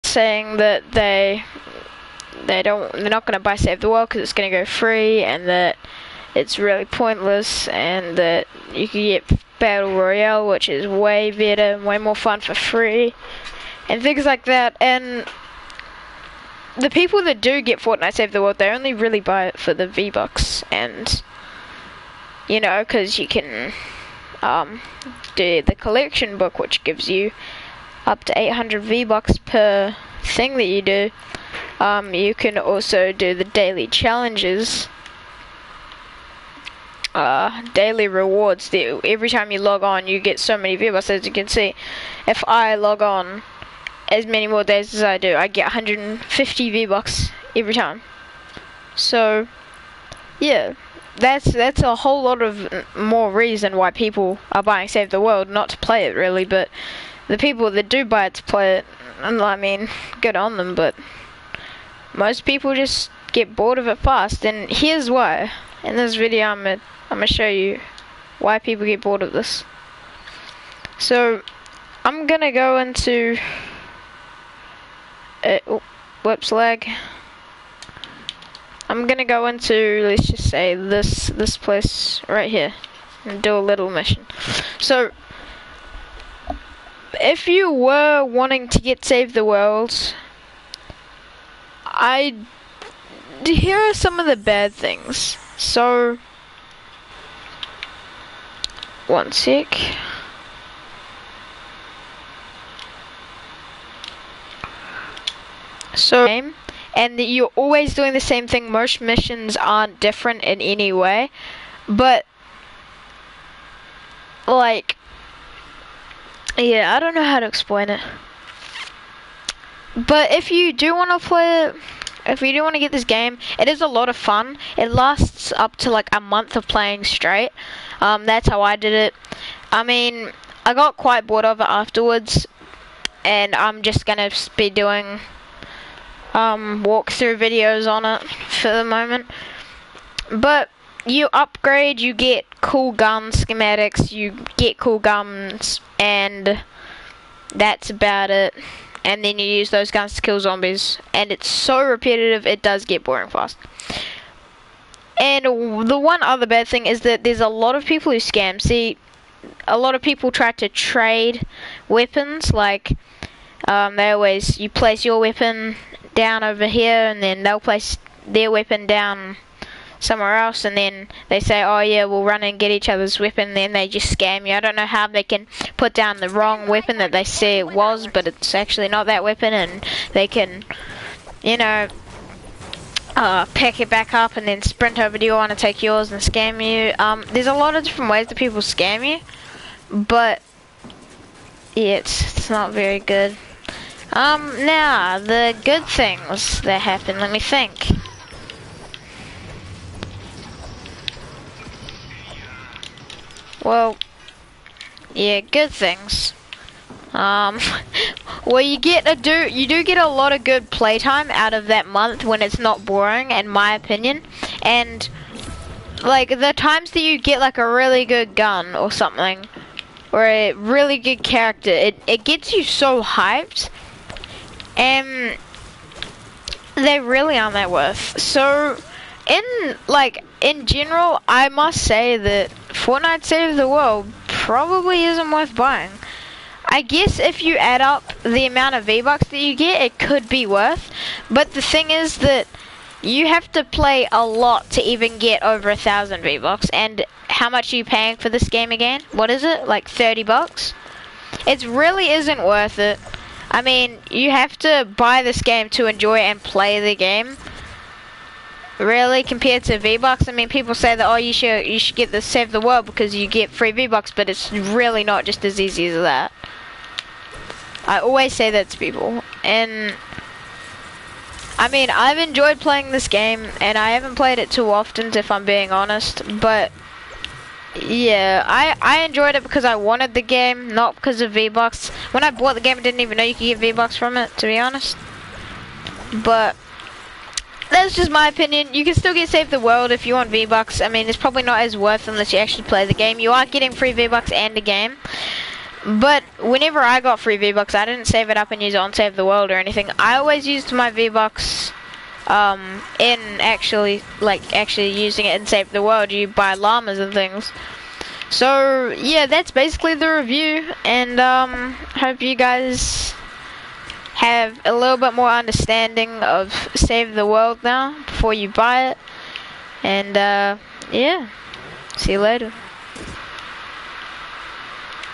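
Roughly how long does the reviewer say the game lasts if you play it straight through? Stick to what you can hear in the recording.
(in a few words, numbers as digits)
a month.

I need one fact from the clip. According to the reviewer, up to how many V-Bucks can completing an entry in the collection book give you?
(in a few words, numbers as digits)
800.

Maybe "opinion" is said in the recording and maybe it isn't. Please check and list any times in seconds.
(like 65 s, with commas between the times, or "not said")
213 s, 288 s.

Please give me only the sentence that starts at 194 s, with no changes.
Um, now, the good things that happen, let me think.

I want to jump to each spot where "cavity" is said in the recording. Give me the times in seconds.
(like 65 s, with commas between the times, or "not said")
not said.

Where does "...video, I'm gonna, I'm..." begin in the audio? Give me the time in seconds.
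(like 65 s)
66 s.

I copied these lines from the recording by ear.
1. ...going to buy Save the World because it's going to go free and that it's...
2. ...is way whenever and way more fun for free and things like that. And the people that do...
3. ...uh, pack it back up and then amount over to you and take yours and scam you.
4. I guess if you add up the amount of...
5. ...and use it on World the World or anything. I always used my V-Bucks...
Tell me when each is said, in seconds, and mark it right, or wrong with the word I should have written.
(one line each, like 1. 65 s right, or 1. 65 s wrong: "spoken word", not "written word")
1. 3 s right
2. 10 s wrong: "better", not "whenever"
3. 183 s wrong: "sprint", not "amount"
4. 236 s right
5. 298 s wrong: "Save", not "World".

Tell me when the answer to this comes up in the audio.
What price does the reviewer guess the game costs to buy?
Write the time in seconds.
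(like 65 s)
249 s.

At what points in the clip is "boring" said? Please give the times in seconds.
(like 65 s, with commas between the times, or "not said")
153 s, 212 s.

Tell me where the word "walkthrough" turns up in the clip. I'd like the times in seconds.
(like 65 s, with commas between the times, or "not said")
136 s.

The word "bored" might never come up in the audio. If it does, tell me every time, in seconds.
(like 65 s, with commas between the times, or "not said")
63 s, 69 s, 131 s.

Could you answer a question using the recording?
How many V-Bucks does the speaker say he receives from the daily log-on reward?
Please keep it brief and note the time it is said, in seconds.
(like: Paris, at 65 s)
150, at 45 s.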